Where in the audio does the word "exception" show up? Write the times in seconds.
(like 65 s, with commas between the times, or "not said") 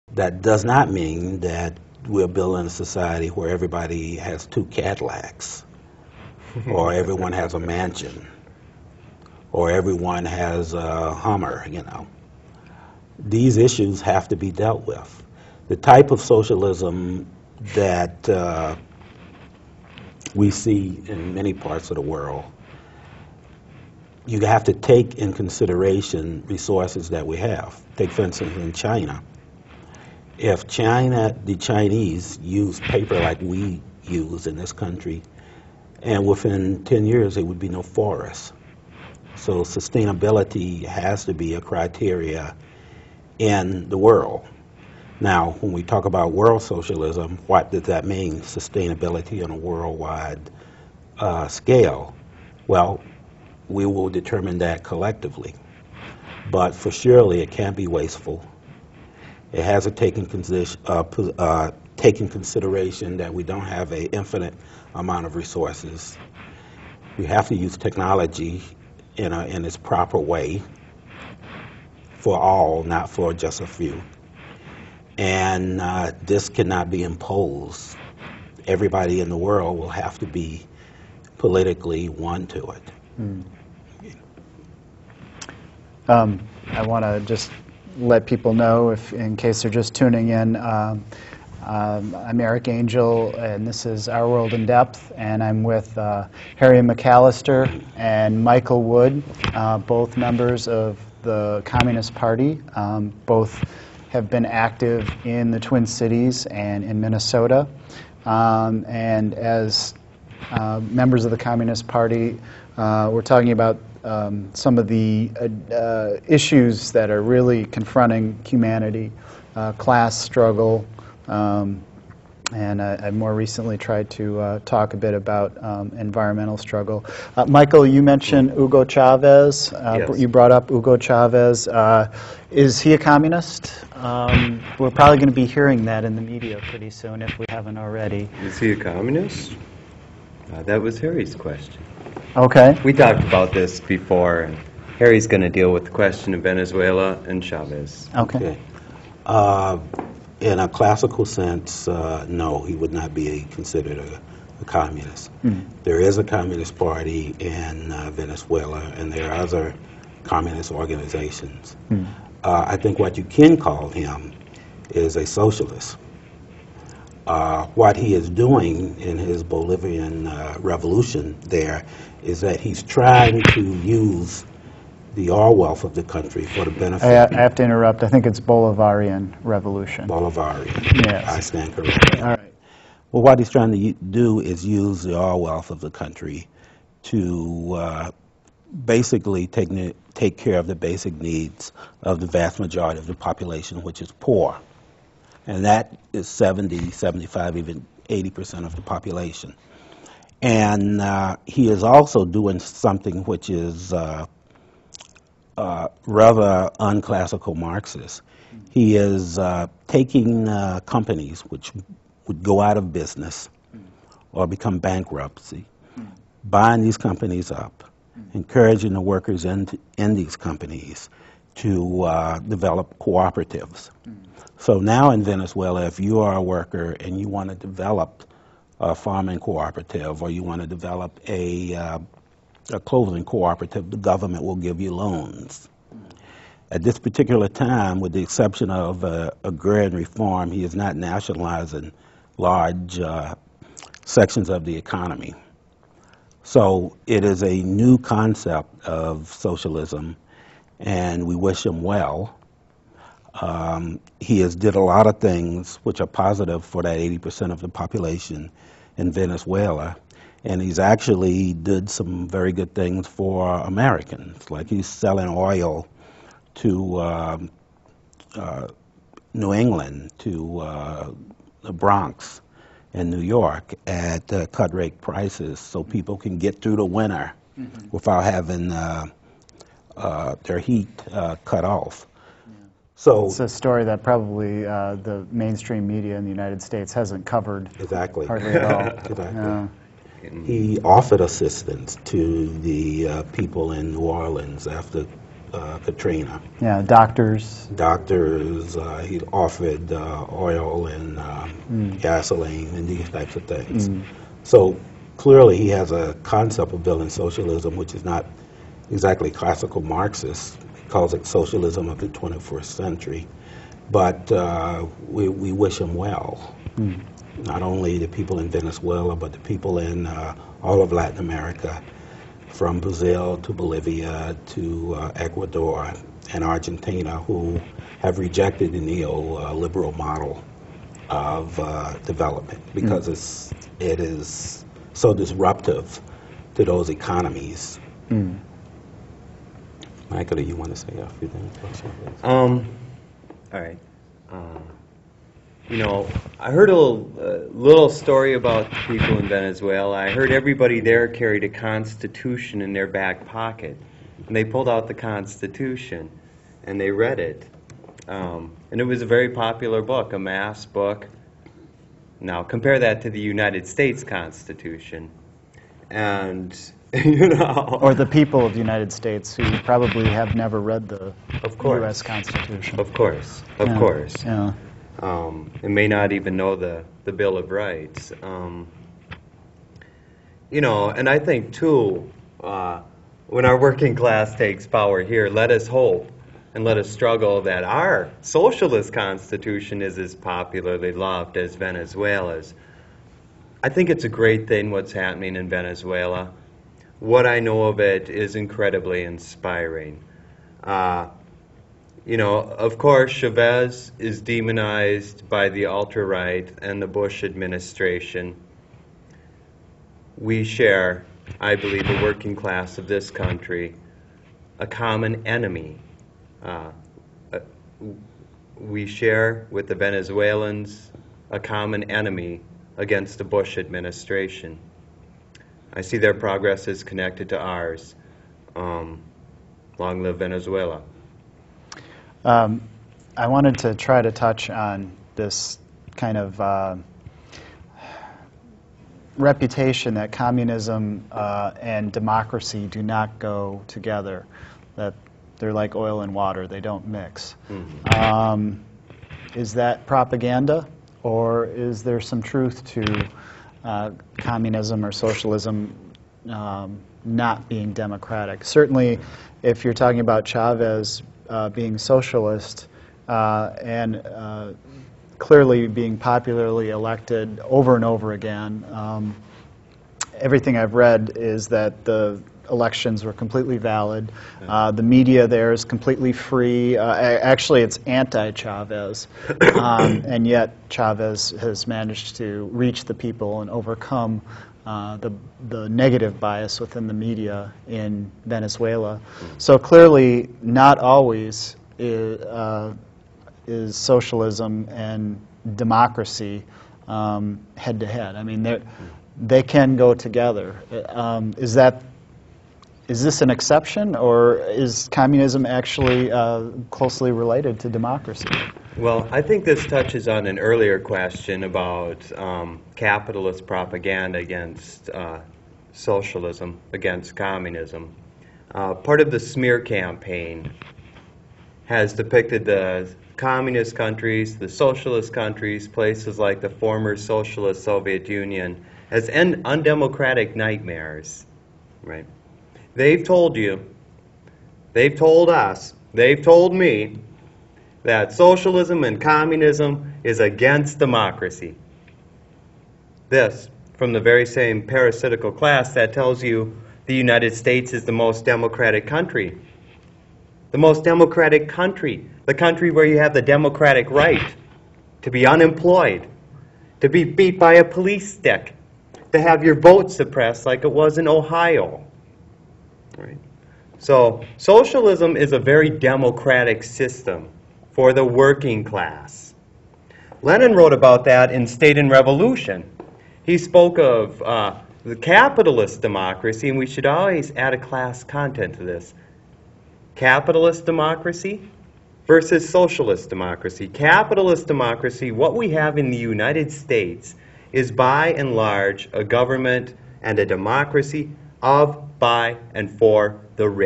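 238 s, 503 s.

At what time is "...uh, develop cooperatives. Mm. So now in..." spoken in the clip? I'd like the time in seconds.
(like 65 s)
222 s.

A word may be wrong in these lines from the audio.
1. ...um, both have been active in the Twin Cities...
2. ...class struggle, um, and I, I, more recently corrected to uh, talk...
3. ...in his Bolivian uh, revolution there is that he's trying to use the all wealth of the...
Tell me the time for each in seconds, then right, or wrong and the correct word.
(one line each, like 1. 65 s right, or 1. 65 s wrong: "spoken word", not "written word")
1. 102 s right
2. 119 s wrong: "tried", not "corrected"
3. 168 s right.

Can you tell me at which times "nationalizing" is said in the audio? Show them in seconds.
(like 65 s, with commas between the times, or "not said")
240 s.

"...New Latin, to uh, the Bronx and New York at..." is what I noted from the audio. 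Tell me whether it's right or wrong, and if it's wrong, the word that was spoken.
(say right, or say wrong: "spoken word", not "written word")
wrong: "England", not "Latin".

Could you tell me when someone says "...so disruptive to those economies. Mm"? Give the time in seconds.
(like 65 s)
334 s.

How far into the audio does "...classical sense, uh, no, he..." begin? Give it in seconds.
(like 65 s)
150 s.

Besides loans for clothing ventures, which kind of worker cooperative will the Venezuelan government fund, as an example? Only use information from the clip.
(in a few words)
farming cooperative.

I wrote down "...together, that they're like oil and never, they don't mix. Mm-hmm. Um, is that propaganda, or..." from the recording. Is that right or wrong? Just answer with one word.
wrong.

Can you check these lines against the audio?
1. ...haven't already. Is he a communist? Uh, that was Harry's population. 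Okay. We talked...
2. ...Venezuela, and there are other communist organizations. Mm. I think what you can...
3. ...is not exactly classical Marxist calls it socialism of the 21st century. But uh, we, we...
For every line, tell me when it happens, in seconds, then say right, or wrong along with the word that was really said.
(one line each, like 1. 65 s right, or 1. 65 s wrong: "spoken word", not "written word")
1. 137 s wrong: "question", not "population"
2. 158 s right
3. 307 s right.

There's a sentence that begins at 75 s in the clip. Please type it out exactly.
And uh, this cannot be imposed.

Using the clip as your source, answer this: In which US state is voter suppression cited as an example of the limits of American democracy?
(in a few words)
Ohio.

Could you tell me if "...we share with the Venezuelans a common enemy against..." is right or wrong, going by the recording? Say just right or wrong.
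right.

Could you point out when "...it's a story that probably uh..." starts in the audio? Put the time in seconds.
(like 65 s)
283 s.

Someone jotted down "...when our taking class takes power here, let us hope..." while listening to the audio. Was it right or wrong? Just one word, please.
wrong.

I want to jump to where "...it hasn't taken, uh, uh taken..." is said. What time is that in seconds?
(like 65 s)
59 s.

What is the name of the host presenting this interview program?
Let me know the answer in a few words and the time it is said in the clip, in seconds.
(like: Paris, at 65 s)
Eric Angel, at 92 s.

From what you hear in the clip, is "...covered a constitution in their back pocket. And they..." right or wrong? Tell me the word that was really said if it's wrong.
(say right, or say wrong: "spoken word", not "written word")
wrong: "carried", not "covered".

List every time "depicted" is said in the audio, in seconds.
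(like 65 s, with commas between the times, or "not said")
521 s.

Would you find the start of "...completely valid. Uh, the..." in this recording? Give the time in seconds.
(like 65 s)
473 s.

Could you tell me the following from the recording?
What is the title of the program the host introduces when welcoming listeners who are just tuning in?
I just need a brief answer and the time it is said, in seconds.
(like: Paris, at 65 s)
Our World in Depth, at 94 s.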